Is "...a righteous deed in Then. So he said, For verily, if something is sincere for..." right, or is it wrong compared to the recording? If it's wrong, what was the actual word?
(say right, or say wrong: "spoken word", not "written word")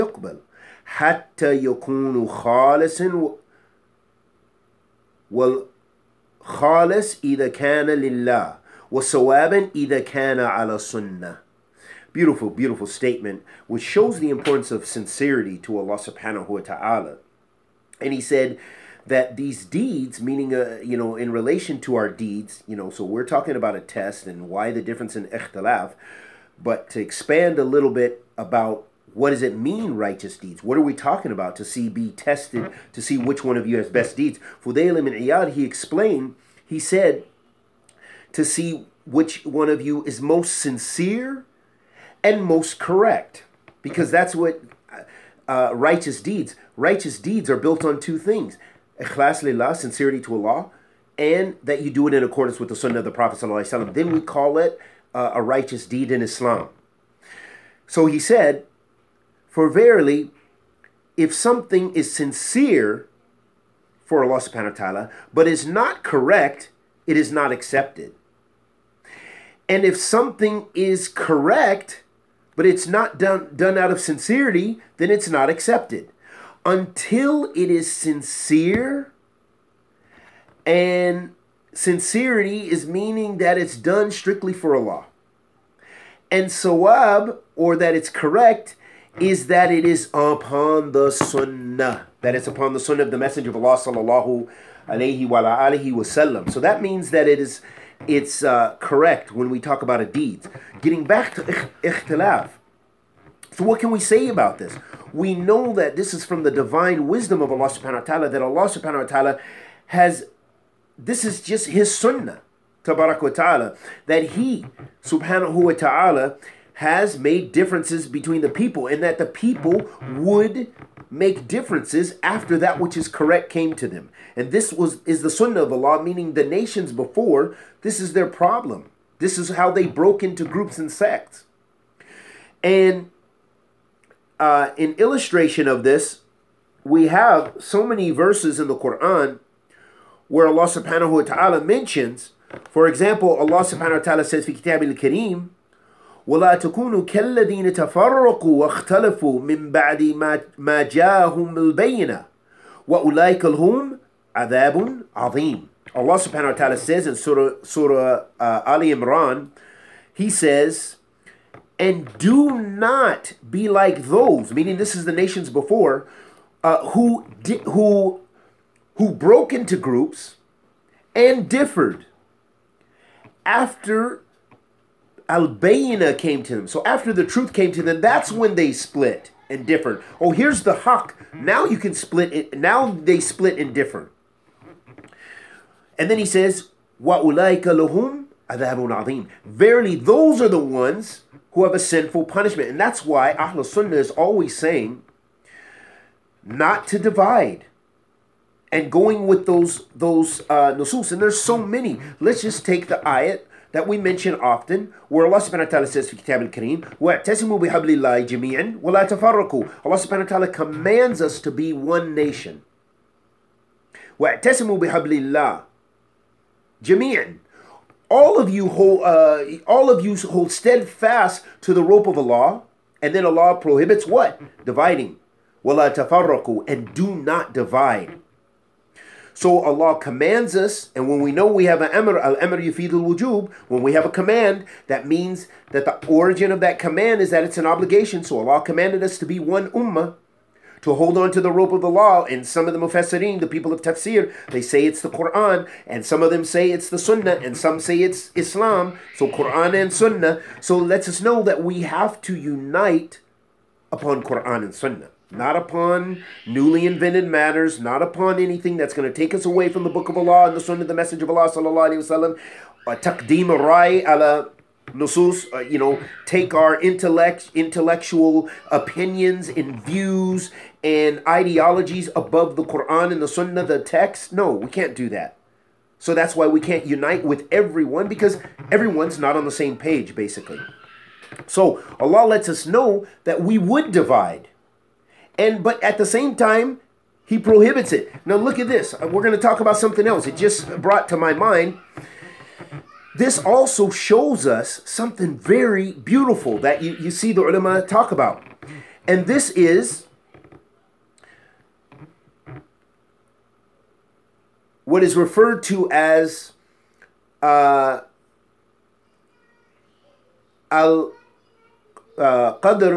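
wrong: "Islam", not "Then".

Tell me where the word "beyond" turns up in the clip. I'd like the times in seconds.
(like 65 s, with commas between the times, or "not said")
not said.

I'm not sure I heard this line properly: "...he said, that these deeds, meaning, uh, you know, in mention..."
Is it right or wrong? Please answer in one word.
wrong.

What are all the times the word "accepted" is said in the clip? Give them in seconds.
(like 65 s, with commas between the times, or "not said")
67 s, 75 s.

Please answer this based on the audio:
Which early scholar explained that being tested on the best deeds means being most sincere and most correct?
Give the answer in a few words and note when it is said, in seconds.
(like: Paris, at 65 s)
Fudayl Iyad, at 34 s.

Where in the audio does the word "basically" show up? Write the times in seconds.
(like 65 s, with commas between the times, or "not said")
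280 s.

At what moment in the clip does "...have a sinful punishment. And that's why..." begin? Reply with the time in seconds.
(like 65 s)
191 s.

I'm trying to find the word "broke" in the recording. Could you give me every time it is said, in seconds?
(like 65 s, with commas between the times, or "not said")
129 s, 169 s.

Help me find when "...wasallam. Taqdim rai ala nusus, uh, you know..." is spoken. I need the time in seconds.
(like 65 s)
262 s.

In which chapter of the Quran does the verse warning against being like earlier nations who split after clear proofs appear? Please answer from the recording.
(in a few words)
Ali Imran.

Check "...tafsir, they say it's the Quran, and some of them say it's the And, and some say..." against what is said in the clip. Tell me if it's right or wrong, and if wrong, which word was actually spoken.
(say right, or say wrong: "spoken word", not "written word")
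wrong: "Sunnah", not "And".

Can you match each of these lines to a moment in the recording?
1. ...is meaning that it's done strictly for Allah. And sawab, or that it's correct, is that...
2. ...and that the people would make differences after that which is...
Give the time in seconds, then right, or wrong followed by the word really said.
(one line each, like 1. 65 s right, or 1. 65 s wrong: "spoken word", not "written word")
1. 82 s right
2. 118 s right.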